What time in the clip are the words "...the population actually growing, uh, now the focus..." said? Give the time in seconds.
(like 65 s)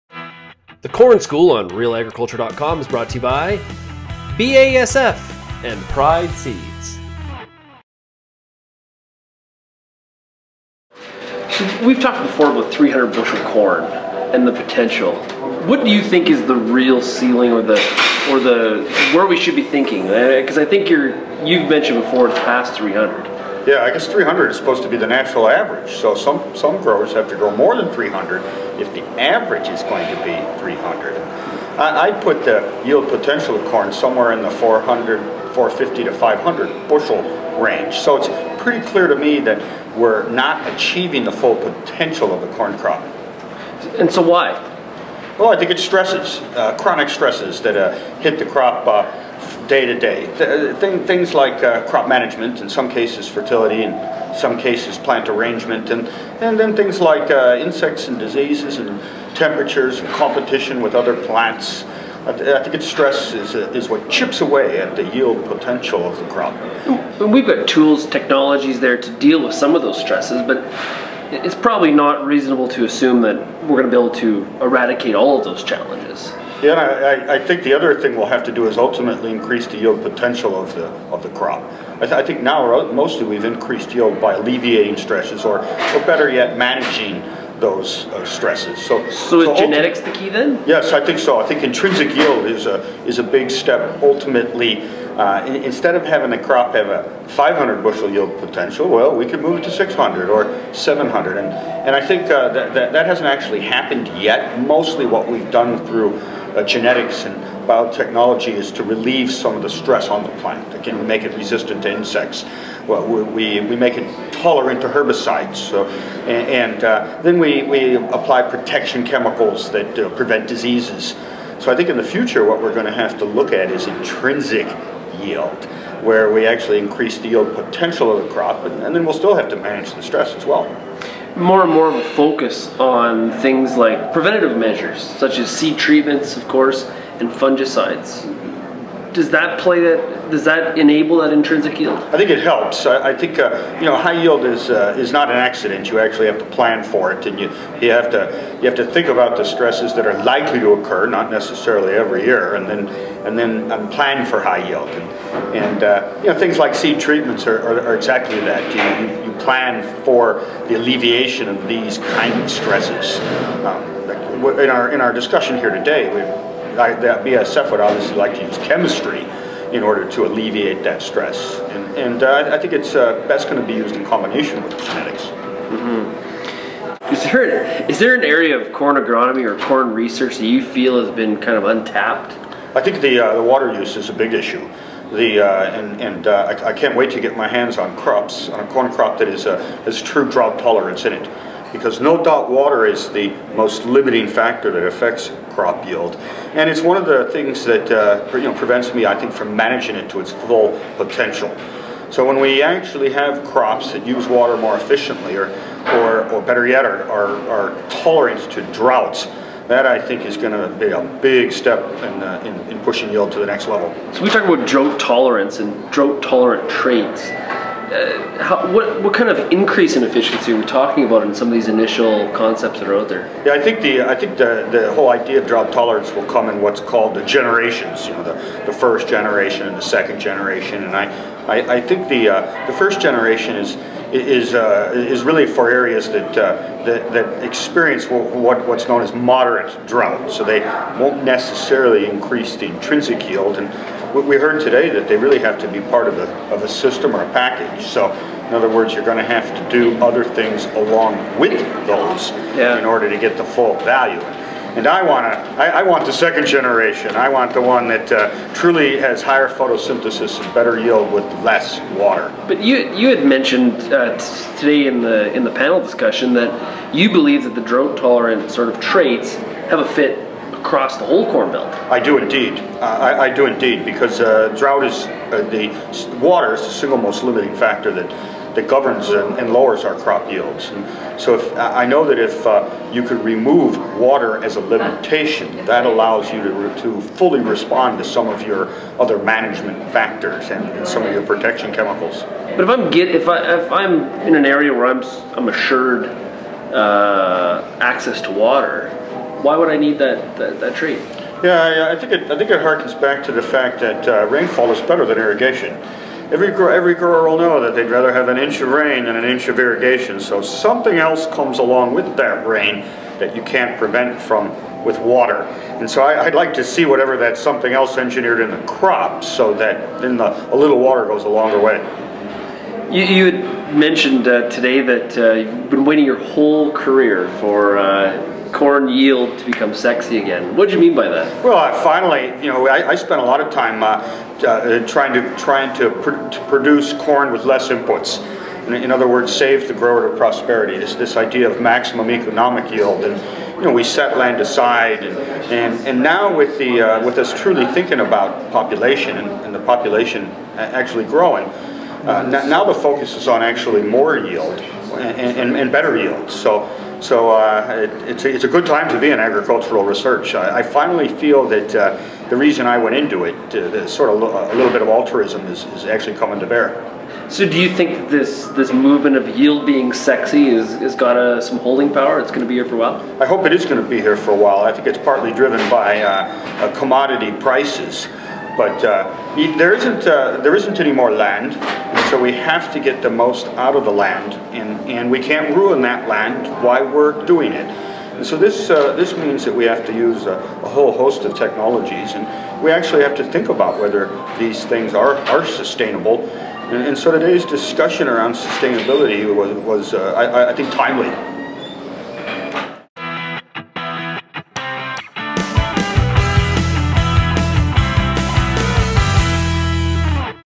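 349 s.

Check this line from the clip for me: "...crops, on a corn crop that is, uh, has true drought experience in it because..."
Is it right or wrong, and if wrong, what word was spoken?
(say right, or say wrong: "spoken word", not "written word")
wrong: "tolerance", not "experience".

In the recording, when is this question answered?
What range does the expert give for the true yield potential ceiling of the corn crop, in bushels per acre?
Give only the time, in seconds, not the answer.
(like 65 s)
35 s.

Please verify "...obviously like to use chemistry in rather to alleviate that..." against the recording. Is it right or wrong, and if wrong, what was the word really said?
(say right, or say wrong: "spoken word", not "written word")
wrong: "order", not "rather".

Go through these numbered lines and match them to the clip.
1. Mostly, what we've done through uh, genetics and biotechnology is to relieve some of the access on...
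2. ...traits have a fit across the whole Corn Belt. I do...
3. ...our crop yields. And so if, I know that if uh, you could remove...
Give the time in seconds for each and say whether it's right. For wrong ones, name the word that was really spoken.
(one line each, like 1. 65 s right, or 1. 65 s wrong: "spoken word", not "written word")
1. 104 s wrong: "stress", not "access"
2. 268 s right
3. 279 s right.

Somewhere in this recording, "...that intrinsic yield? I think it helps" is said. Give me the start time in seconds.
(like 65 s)
141 s.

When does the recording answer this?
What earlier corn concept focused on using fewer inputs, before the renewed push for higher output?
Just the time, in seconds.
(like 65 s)
341 s.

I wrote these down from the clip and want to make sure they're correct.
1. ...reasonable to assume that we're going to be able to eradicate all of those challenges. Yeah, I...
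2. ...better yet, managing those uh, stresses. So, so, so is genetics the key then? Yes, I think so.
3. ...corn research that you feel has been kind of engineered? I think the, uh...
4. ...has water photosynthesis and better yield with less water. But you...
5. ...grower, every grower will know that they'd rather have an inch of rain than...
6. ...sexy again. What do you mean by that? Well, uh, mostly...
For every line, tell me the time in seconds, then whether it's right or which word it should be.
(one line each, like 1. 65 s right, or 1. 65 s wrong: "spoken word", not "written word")
1. 72 s right
2. 86 s right
3. 179 s wrong: "untapped", not "engineered"
4. 258 s wrong: "higher", not "water"
5. 306 s right
6. 329 s wrong: "finally", not "mostly".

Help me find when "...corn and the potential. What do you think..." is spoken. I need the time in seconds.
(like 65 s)
13 s.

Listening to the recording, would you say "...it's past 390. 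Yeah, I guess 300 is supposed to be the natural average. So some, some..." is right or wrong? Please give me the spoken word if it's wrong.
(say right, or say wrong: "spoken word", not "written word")
wrong: "300", not "390".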